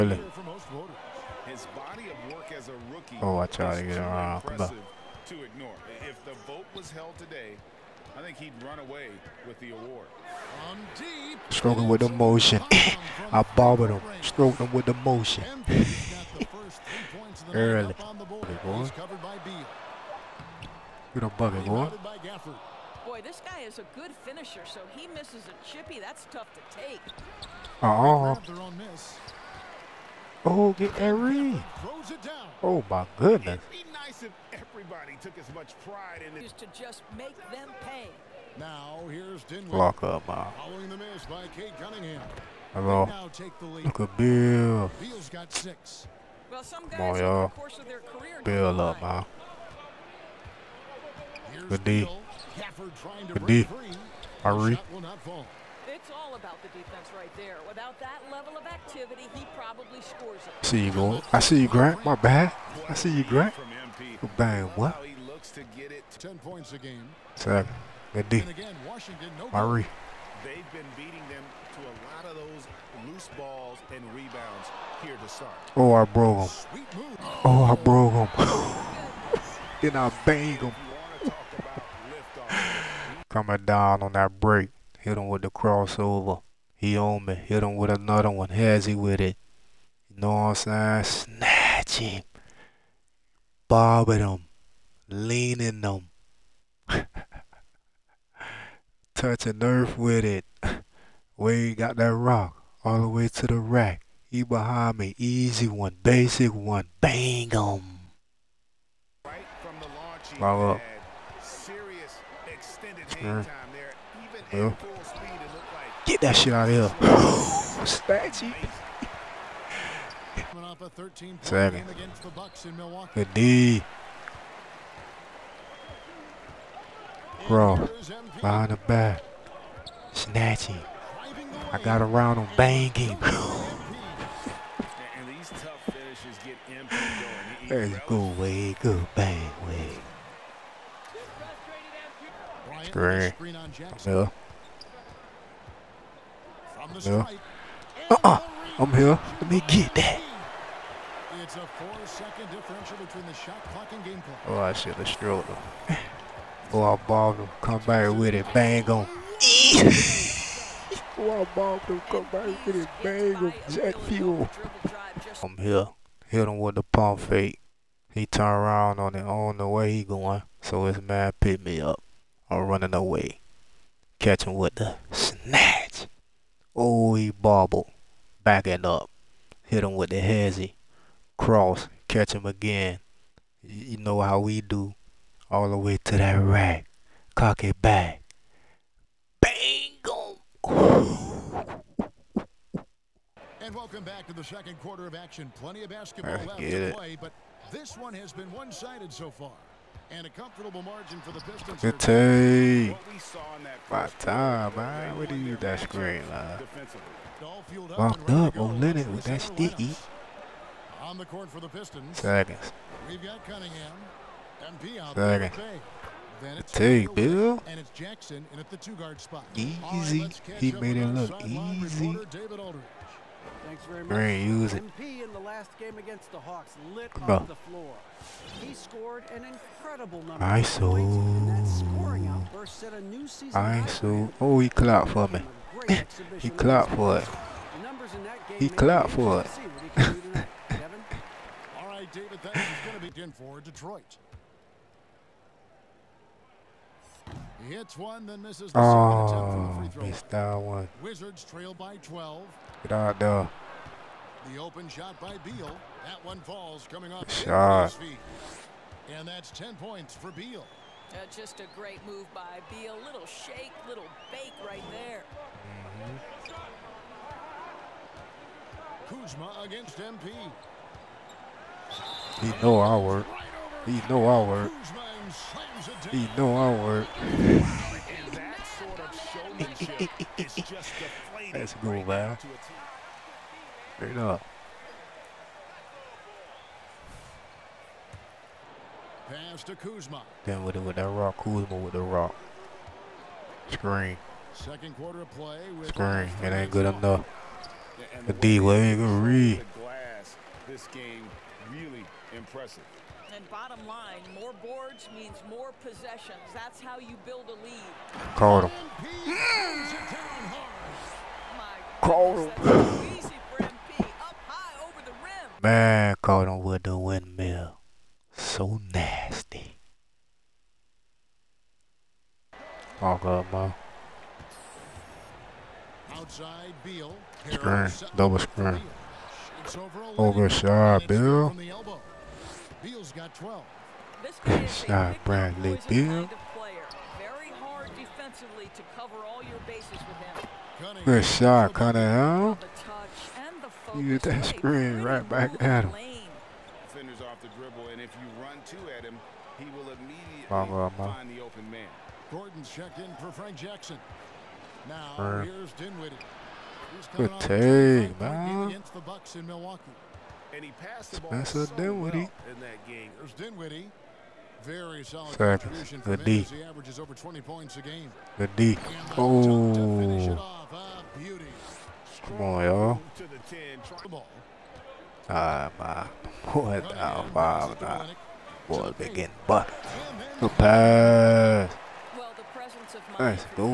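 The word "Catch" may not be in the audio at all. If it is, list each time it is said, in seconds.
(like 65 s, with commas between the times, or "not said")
174 s, 182 s.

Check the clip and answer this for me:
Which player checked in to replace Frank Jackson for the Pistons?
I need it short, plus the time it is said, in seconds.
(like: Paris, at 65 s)
Gordon, at 352 s.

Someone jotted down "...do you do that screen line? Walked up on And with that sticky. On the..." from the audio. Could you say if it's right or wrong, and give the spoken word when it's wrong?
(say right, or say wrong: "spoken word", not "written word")
wrong: "Leonard", not "And".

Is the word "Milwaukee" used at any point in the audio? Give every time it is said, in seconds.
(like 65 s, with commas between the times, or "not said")
359 s.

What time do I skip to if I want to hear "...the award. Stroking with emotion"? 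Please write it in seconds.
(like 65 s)
9 s.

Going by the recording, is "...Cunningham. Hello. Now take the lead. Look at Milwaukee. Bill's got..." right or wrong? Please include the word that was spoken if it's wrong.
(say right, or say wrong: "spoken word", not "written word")
wrong: "Bill", not "Milwaukee".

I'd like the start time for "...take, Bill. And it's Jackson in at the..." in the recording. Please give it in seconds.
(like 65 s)
216 s.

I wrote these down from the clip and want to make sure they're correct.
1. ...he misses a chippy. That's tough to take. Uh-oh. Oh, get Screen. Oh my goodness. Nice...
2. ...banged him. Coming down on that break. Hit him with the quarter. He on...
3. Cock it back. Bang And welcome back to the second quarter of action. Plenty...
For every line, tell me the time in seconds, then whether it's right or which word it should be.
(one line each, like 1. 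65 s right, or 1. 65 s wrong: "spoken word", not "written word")
1. 24 s wrong: "Irene", not "Screen"
2. 80 s wrong: "crossover", not "quarter"
3. 187 s right.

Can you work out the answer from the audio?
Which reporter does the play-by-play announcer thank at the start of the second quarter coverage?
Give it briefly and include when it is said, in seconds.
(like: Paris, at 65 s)
David Aldridge, at 222 s.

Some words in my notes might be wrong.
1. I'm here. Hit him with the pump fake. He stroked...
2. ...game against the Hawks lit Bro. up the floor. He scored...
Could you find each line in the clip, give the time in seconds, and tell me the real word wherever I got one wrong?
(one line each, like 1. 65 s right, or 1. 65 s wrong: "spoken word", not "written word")
1. 165 s wrong: "turned", not "stroked"
2. 225 s right.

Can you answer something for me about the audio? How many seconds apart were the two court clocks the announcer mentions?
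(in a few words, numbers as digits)
4.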